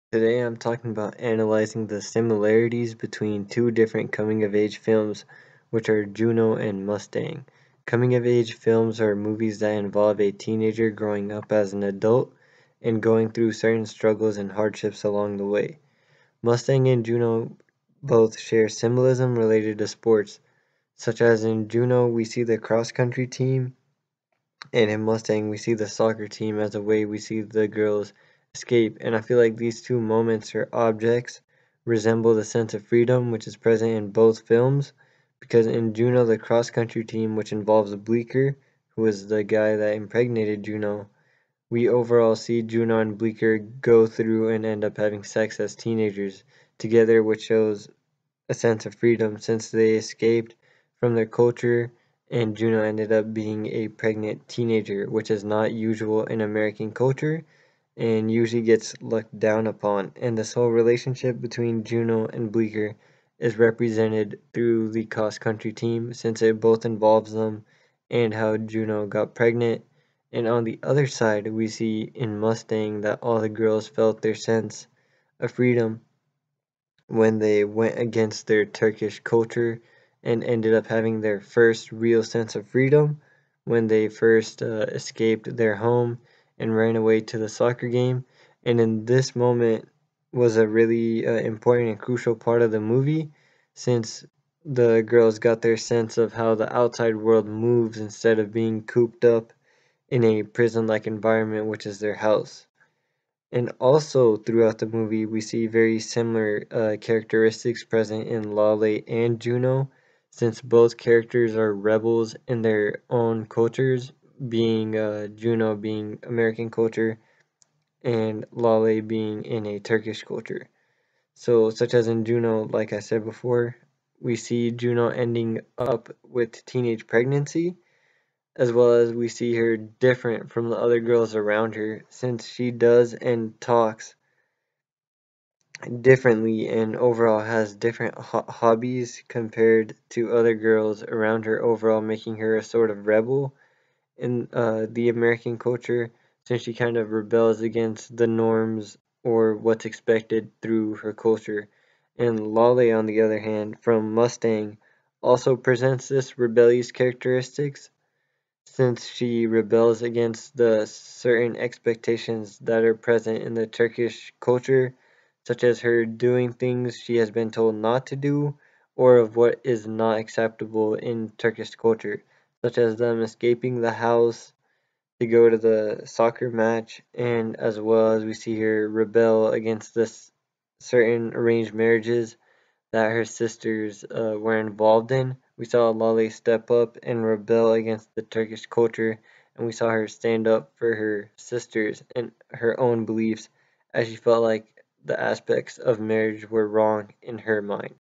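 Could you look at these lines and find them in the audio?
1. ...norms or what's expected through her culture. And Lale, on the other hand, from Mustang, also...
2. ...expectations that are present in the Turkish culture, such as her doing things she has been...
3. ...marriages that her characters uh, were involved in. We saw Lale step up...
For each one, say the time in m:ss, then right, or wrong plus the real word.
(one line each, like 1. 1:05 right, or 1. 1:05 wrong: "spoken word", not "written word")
1. 2:28 right
2. 2:41 right
3. 3:01 wrong: "sisters", not "characters".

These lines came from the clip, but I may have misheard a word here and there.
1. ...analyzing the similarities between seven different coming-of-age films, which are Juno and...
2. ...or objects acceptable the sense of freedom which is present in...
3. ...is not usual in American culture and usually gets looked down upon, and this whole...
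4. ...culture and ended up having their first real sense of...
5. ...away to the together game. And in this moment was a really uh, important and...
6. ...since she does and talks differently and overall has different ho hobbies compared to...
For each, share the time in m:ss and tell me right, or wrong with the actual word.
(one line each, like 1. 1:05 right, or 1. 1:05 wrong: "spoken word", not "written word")
1. 0:01 wrong: "two", not "seven"
2. 0:30 wrong: "resemble", not "acceptable"
3. 0:55 right
4. 1:19 right
5. 1:26 wrong: "soccer", not "together"
6. 2:12 right.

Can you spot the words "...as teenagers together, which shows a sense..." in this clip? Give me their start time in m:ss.
0:45.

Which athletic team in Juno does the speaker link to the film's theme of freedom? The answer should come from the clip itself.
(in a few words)
cross-country team.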